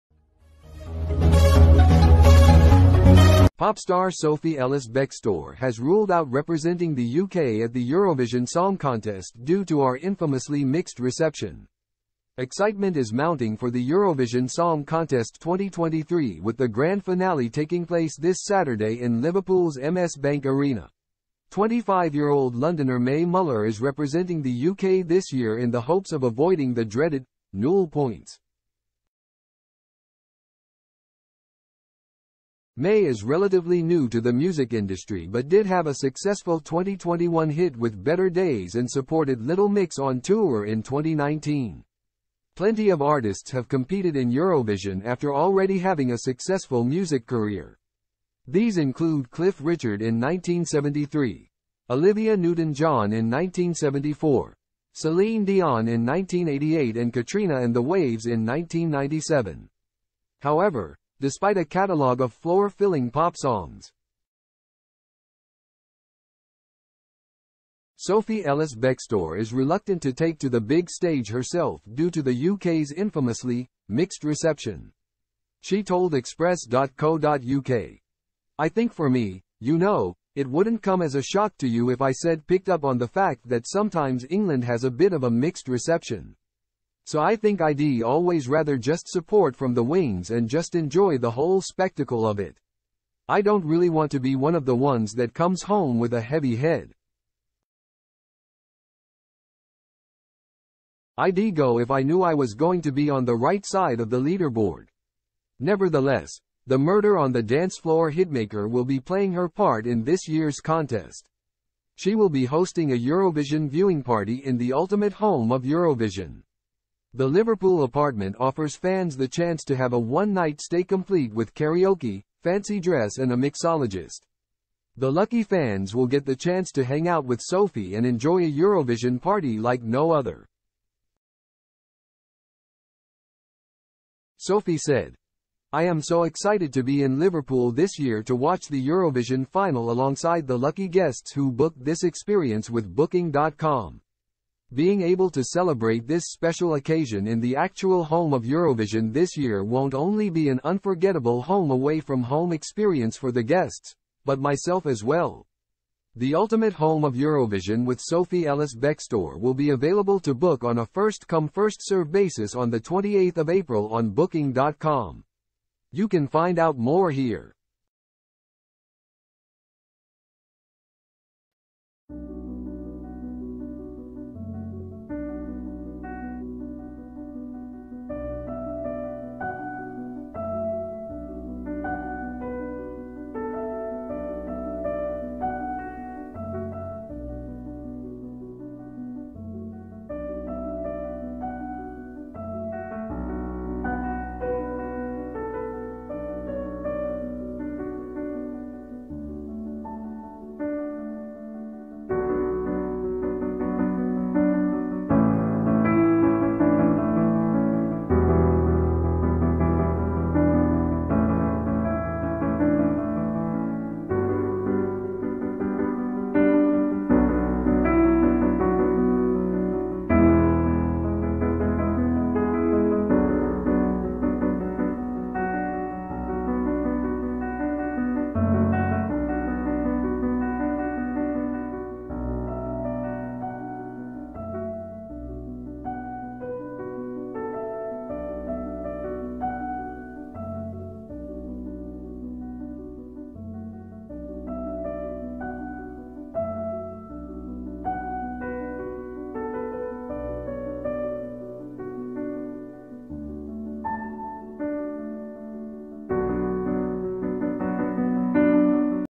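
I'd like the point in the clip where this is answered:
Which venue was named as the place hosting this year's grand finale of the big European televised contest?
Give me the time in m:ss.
0:19.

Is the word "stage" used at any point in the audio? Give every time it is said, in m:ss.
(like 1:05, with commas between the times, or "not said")
1:10.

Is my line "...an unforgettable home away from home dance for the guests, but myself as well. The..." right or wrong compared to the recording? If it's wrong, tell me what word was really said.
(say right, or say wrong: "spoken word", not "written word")
wrong: "experience", not "dance".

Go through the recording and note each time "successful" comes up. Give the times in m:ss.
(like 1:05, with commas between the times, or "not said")
0:35, 0:46.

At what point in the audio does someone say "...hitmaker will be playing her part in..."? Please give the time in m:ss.
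1:48.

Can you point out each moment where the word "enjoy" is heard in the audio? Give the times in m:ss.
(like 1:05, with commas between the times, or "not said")
1:30, 2:08.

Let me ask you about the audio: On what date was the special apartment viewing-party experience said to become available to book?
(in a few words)
28 April.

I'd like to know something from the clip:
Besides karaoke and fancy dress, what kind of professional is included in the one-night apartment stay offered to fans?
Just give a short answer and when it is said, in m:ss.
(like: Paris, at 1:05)
Mixologist, at 2:03.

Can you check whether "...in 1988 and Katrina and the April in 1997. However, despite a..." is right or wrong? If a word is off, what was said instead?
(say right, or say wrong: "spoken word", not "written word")
wrong: "Waves", not "April".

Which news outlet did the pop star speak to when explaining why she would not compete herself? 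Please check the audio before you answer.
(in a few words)
Express.co.uk.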